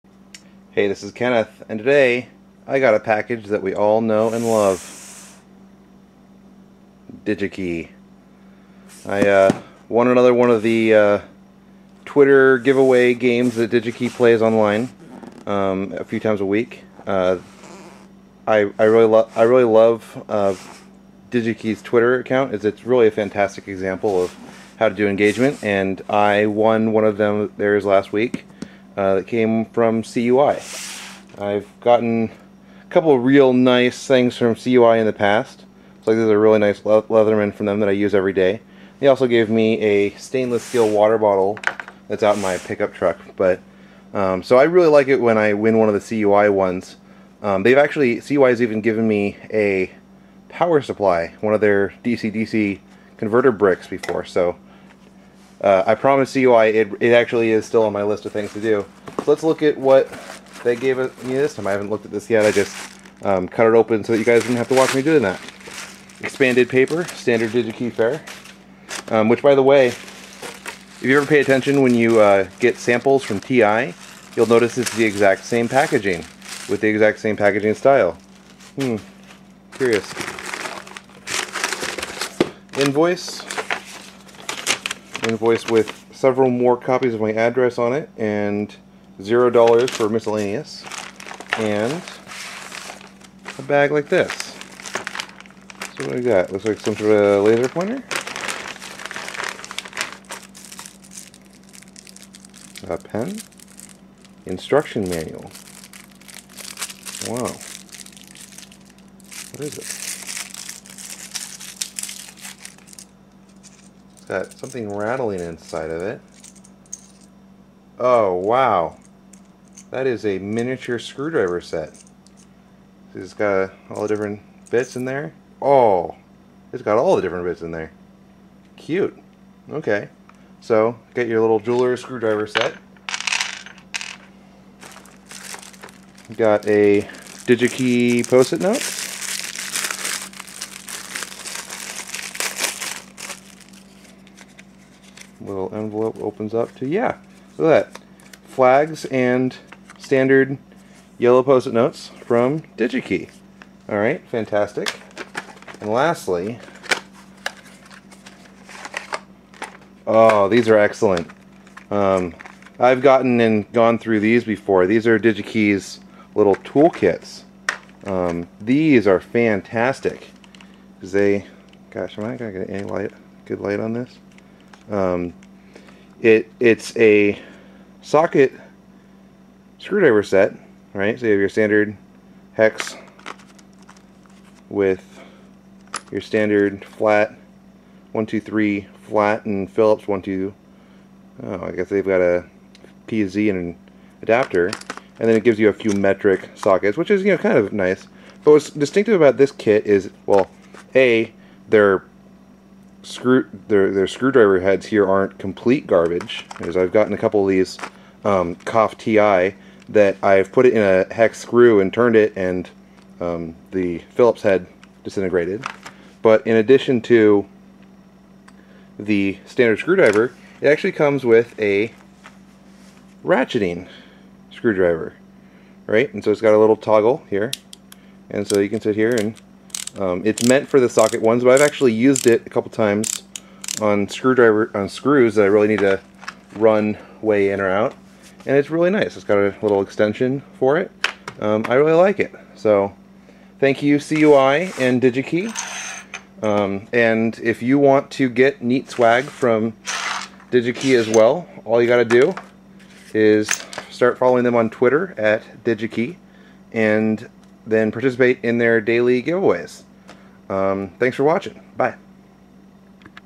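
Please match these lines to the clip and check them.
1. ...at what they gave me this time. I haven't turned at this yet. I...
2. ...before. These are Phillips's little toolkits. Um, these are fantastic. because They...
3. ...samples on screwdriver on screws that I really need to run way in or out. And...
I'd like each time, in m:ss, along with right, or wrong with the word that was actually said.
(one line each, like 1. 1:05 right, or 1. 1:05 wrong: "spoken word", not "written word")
1. 0:59 wrong: "looked", not "turned"
2. 2:44 wrong: "DigiKey", not "Phillips"
3. 3:52 wrong: "times", not "samples".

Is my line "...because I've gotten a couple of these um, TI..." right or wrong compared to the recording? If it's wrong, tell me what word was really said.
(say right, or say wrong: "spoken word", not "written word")
right.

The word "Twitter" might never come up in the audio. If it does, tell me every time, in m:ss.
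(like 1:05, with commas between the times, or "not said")
0:12, 0:21, 4:14.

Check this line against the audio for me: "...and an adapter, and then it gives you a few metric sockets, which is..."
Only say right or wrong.
right.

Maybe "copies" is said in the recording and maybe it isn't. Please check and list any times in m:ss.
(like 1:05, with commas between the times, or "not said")
1:26.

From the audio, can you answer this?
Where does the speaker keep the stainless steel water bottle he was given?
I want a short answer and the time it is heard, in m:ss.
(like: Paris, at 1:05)
pickup truck, at 0:42.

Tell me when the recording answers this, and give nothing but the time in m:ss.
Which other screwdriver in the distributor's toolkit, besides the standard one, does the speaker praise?
3:43.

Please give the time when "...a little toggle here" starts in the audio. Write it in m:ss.
3:46.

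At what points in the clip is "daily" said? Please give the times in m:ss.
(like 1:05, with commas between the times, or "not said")
4:18.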